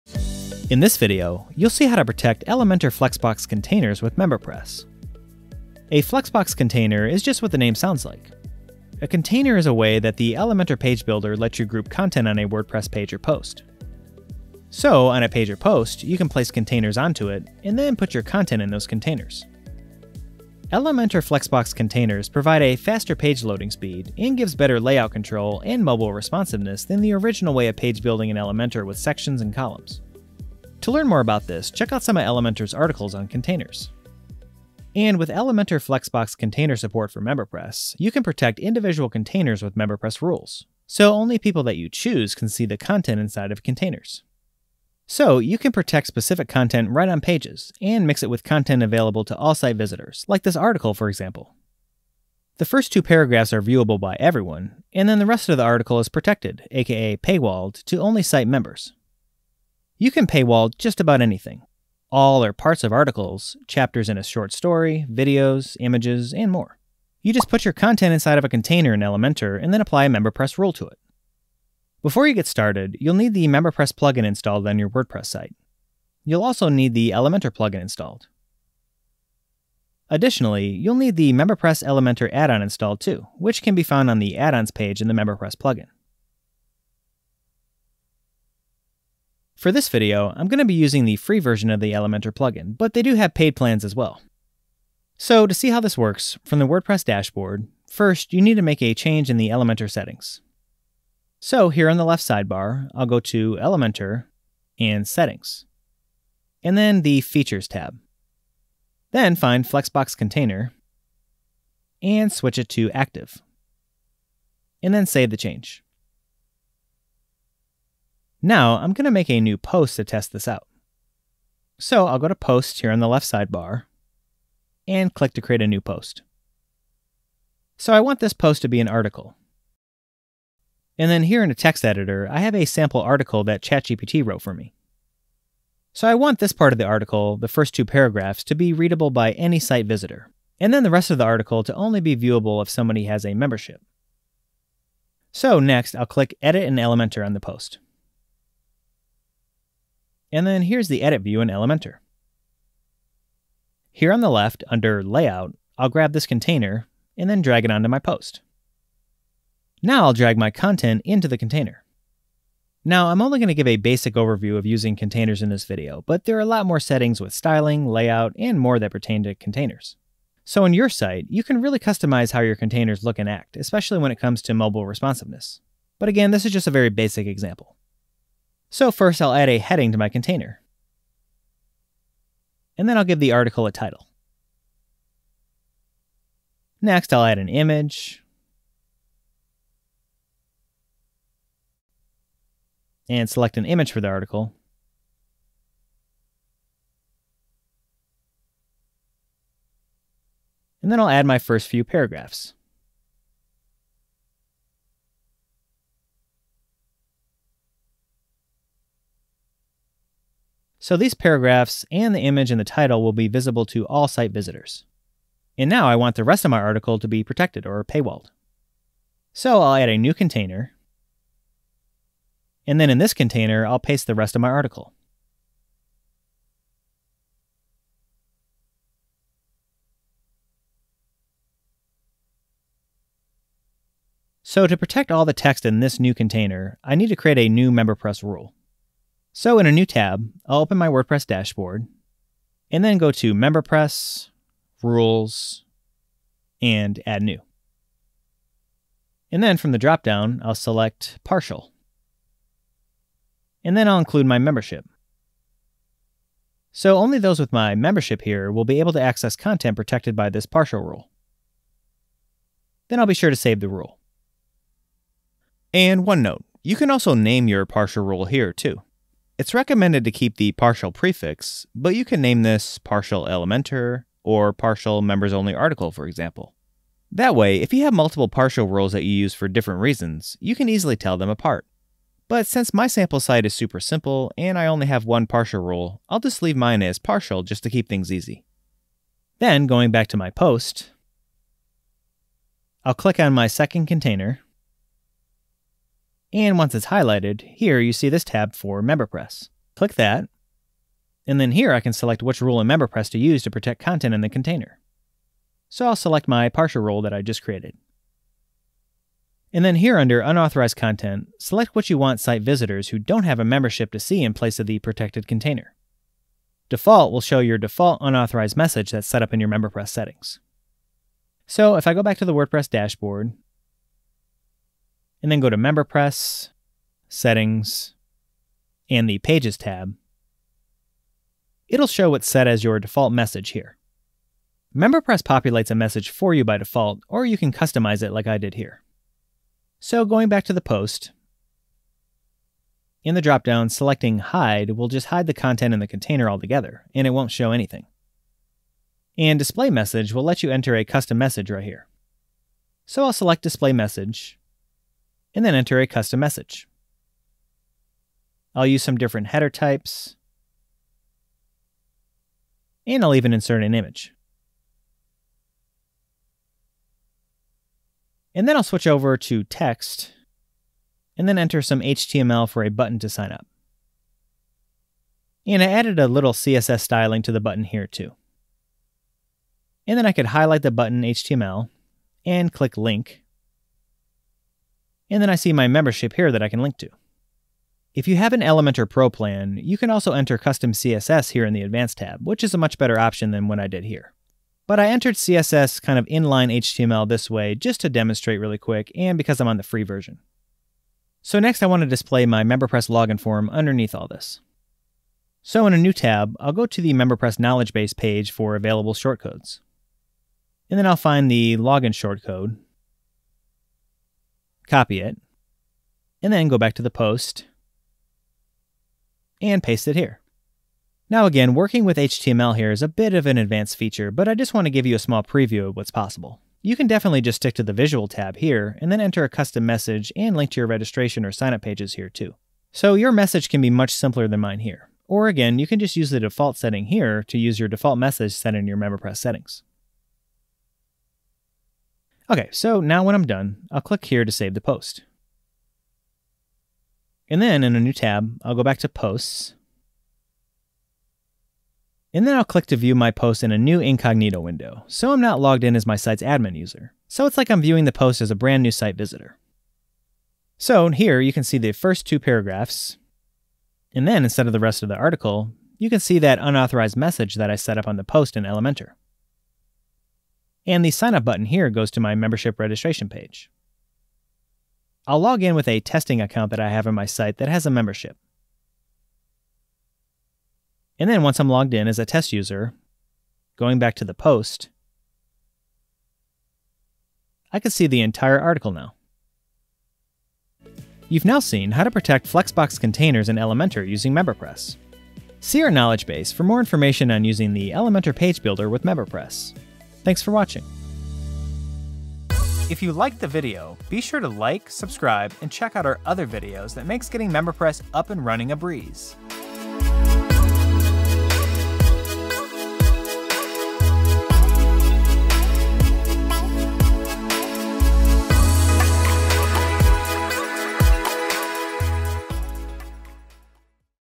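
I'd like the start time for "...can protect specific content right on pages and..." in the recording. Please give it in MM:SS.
00:45.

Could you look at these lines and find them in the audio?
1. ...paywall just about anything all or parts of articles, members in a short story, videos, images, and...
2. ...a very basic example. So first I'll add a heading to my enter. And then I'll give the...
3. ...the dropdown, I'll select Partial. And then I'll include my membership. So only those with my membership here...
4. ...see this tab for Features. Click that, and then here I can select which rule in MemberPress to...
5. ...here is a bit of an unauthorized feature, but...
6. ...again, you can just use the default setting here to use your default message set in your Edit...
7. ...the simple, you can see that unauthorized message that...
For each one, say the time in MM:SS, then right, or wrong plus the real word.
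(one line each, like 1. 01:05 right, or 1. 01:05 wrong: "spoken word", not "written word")
1. 01:00 wrong: "chapters", not "members"
2. 02:56 wrong: "container", not "enter"
3. 04:09 right
4. 04:57 wrong: "MemberPress", not "Features"
5. 07:02 wrong: "advanced", not "unauthorized"
6. 07:15 wrong: "MemberPress", not "Edit"
7. 07:44 wrong: "article", not "simple".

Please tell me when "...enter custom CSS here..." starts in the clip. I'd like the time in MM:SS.
06:30.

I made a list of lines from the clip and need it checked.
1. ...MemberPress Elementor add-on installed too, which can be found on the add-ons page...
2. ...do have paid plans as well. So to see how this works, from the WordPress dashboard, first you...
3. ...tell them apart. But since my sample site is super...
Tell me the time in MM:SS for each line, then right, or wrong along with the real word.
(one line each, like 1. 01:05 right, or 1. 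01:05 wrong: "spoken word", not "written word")
1. 01:21 right
2. 01:33 right
3. 04:40 right.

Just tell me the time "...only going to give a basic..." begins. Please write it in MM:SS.
02:43.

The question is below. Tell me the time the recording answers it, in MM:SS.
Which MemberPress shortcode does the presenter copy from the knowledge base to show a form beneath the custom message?
06:51.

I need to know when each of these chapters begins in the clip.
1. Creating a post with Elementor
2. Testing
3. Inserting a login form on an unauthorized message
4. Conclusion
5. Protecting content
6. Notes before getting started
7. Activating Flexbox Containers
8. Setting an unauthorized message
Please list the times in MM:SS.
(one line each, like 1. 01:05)
1. 01:58
2. 07:25
3. 06:40
4. 08:10
5. 03:35
6. 01:12
7. 01:34
8. 05:09.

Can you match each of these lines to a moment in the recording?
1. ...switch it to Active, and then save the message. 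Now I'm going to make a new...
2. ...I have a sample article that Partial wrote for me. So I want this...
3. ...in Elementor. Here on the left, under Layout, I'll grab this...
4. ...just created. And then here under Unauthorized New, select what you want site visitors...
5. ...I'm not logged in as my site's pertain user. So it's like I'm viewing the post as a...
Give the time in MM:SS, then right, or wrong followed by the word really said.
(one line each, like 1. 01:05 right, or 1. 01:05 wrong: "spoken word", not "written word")
1. 01:52 wrong: "change", not "message"
2. 02:12 wrong: "ChatGPT", not "Partial"
3. 02:31 right
4. 05:07 wrong: "Content", not "New"
5. 07:35 wrong: "admin", not "pertain".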